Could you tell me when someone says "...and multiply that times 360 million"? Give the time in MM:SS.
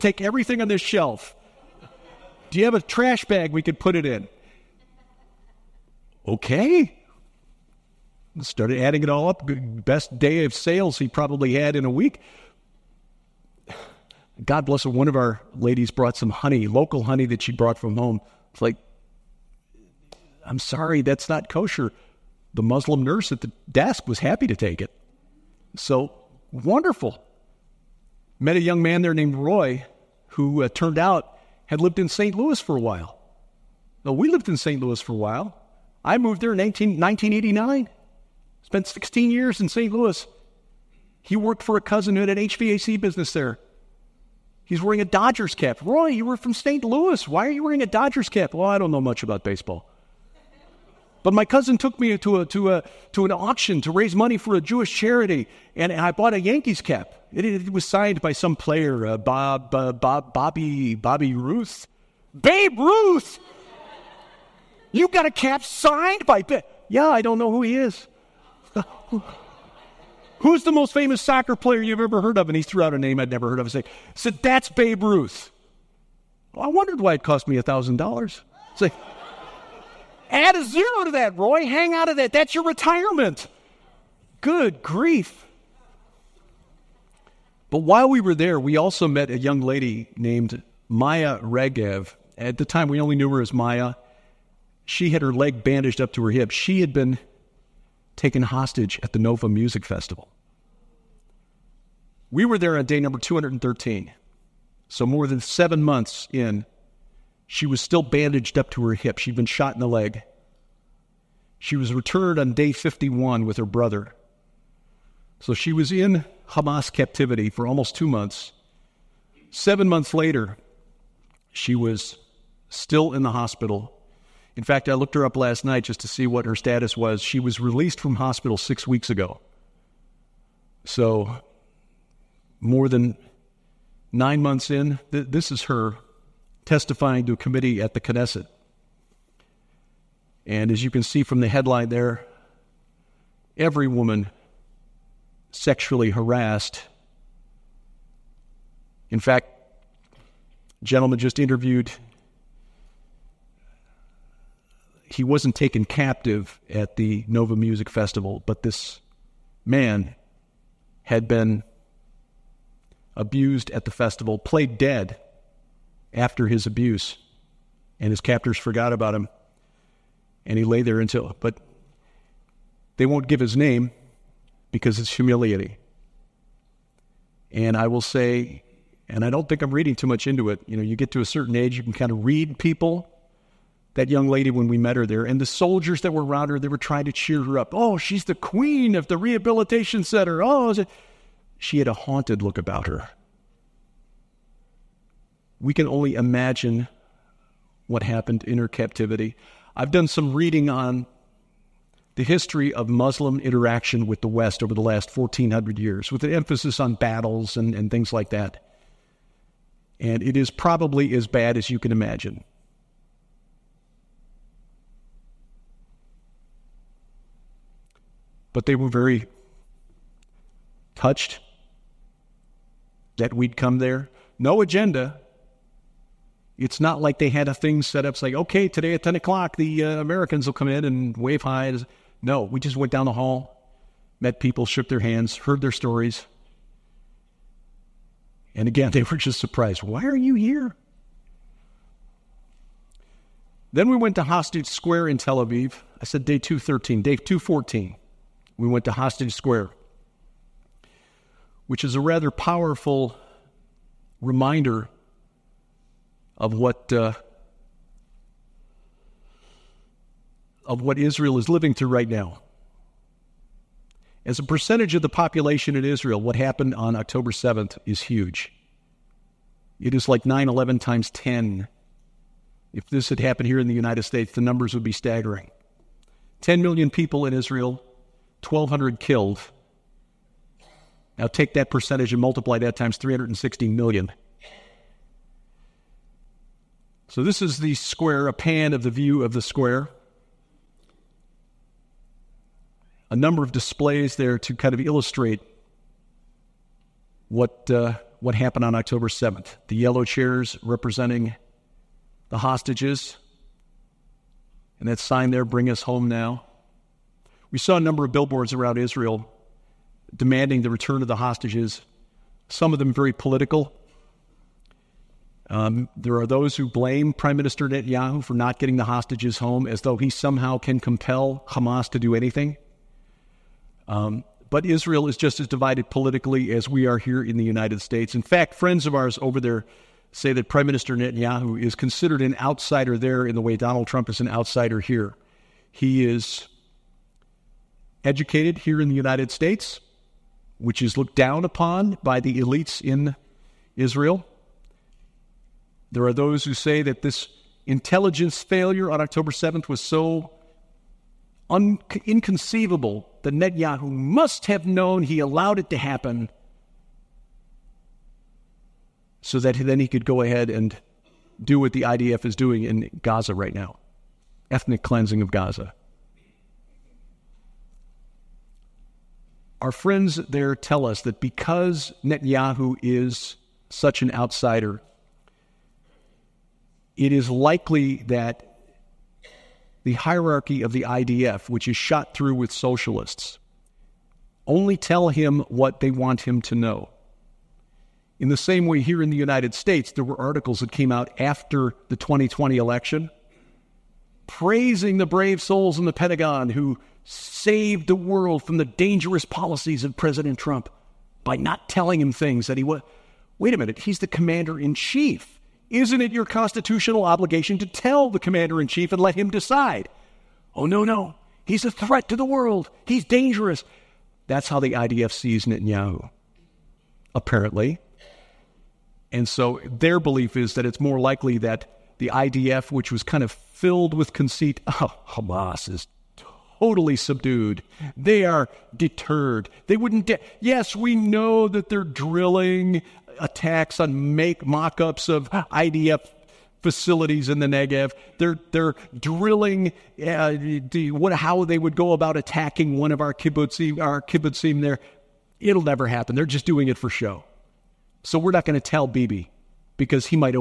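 04:42.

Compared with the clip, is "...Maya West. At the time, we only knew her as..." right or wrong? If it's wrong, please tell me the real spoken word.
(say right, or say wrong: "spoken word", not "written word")
wrong: "Regev", not "West".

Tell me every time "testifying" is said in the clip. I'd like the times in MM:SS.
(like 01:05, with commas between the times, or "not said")
02:16.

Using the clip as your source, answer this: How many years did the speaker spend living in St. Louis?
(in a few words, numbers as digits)
16.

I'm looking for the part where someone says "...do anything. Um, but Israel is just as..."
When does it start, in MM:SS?
05:21.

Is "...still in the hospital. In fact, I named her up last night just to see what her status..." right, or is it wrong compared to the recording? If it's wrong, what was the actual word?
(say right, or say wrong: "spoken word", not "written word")
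wrong: "looked", not "named".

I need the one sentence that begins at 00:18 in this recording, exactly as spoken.
It's like, I'm sorry, that's not kosher the Muslim nurse at the desk was happy to take it.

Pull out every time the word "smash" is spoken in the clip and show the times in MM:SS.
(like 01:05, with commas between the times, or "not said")
not said.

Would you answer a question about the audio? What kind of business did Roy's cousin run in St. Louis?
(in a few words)
HVAC.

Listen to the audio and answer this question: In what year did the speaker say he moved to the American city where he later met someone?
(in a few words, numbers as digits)
1989.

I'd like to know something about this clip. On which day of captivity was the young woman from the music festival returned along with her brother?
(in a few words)
Day 51.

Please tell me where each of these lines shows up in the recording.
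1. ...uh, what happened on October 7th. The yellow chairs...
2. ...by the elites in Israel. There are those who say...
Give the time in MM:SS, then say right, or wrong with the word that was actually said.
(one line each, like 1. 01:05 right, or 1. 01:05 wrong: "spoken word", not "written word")
1. 04:57 right
2. 05:42 right.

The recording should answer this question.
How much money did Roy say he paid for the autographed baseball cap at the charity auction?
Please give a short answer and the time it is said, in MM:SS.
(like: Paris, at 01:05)
$1,000, at 01:17.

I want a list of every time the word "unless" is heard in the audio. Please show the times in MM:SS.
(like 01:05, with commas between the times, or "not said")
not said.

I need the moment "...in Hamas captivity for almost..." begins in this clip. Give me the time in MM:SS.
01:55.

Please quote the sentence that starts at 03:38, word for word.
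But they were very touched that we'd come there.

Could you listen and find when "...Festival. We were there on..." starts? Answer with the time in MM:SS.
01:39.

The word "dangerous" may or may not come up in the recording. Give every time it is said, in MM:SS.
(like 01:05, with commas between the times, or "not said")
06:38, 06:53.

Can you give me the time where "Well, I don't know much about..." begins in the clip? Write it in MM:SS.
00:48.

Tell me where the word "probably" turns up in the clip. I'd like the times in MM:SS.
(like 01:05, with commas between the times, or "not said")
00:11, 03:30.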